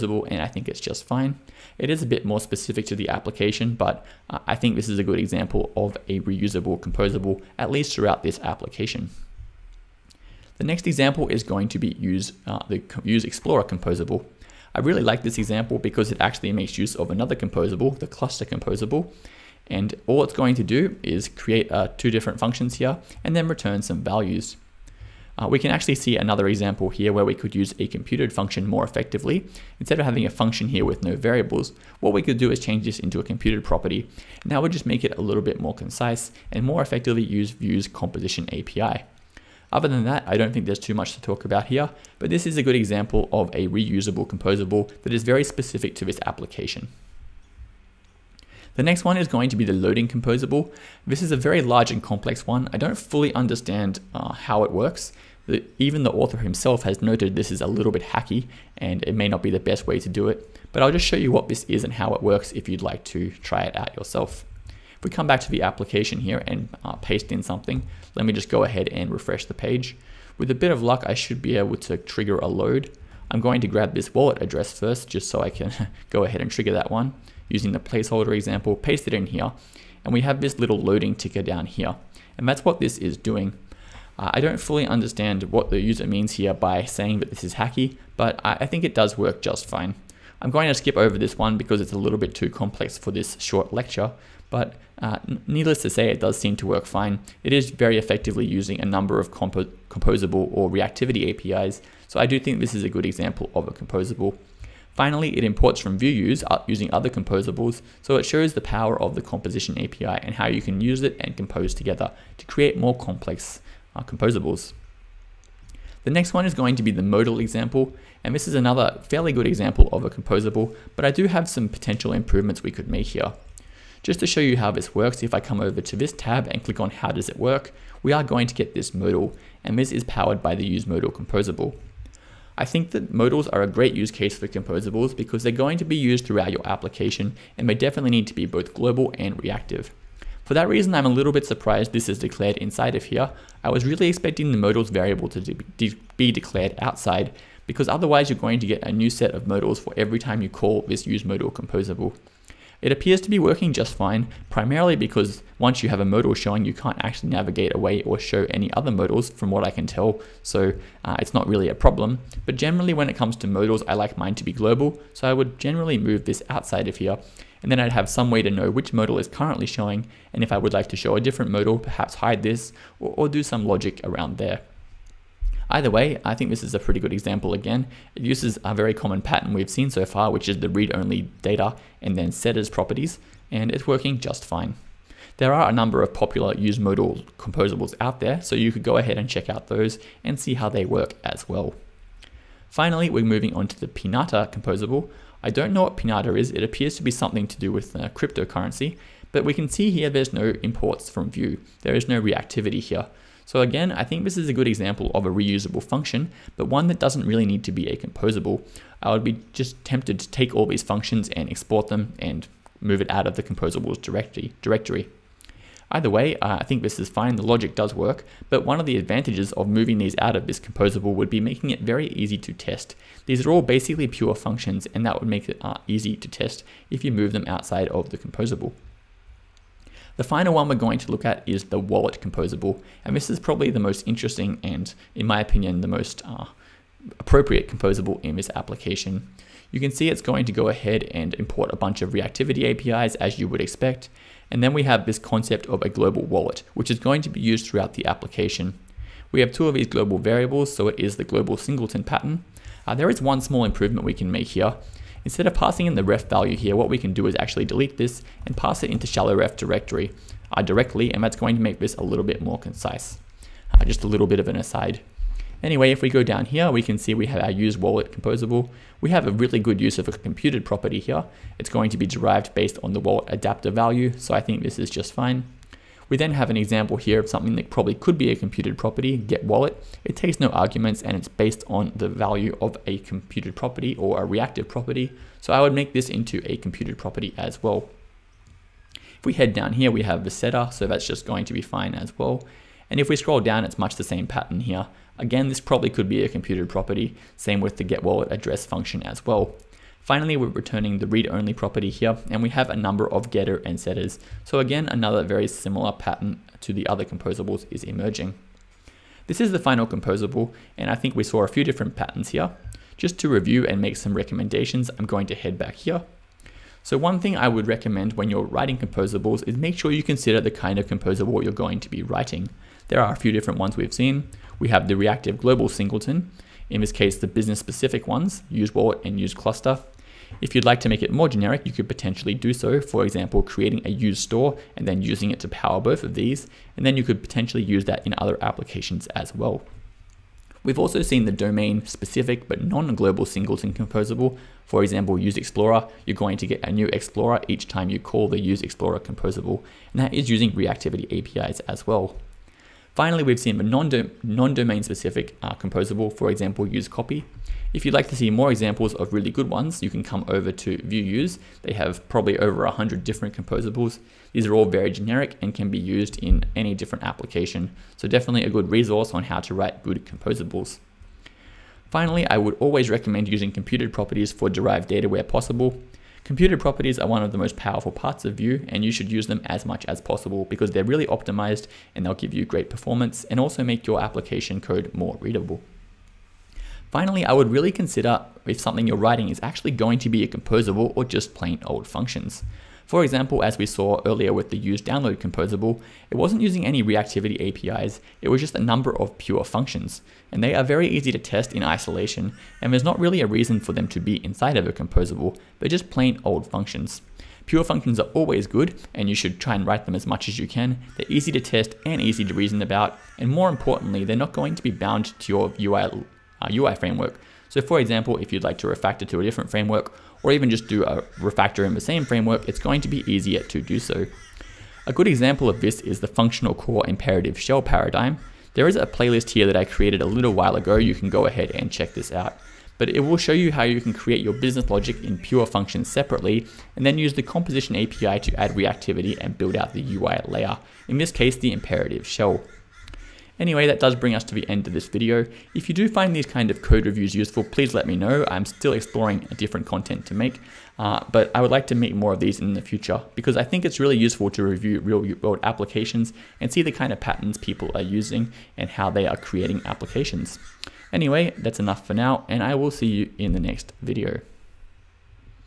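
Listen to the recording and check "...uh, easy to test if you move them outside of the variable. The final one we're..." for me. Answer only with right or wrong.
wrong.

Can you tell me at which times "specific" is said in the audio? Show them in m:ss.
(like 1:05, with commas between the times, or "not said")
0:02, 0:45, 5:27, 5:41, 5:54.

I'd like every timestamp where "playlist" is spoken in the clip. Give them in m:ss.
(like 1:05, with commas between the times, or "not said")
7:08.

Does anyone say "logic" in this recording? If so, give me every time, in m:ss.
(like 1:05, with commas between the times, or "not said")
2:53, 3:37, 7:14.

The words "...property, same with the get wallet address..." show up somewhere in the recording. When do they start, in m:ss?
4:56.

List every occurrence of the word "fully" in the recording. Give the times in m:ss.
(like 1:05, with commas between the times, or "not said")
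0:52, 1:24.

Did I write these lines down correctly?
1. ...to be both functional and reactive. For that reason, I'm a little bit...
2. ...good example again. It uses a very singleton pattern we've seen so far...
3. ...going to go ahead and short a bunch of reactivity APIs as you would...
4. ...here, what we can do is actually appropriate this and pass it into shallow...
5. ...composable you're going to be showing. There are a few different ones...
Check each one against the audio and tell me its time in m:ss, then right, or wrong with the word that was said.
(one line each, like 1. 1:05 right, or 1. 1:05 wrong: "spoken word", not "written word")
1. 2:18 wrong: "global", not "functional"
2. 2:57 wrong: "common", not "singleton"
3. 4:00 wrong: "import", not "short"
4. 4:16 wrong: "delete", not "appropriate"
5. 5:20 wrong: "writing", not "showing".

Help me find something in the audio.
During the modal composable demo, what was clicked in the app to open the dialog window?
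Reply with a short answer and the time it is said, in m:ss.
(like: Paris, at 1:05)
How does it work, at 2:06.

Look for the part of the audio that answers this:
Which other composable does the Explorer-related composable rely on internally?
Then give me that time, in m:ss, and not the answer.
0:17.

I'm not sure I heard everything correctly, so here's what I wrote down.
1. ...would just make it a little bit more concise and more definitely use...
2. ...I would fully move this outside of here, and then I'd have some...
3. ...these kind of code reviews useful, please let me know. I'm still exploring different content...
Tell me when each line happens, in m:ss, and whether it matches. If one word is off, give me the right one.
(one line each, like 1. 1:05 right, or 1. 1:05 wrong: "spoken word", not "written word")
1. 0:34 wrong: "effectively", not "definitely"
2. 2:45 wrong: "generally", not "fully"
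3. 7:26 right.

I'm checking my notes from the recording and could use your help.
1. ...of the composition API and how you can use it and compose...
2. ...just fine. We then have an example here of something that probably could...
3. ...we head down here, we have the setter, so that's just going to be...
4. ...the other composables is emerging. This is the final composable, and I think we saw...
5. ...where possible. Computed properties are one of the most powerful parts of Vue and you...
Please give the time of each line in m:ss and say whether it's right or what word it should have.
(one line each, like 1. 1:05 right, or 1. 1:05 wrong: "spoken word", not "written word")
1. 1:49 right
2. 4:34 right
3. 4:49 right
4. 5:06 right
5. 6:15 right.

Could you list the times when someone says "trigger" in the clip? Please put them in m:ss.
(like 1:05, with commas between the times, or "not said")
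1:11, 1:16.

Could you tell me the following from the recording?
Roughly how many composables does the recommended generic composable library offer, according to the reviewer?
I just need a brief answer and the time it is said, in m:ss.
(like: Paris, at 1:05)
over 100, at 6:02.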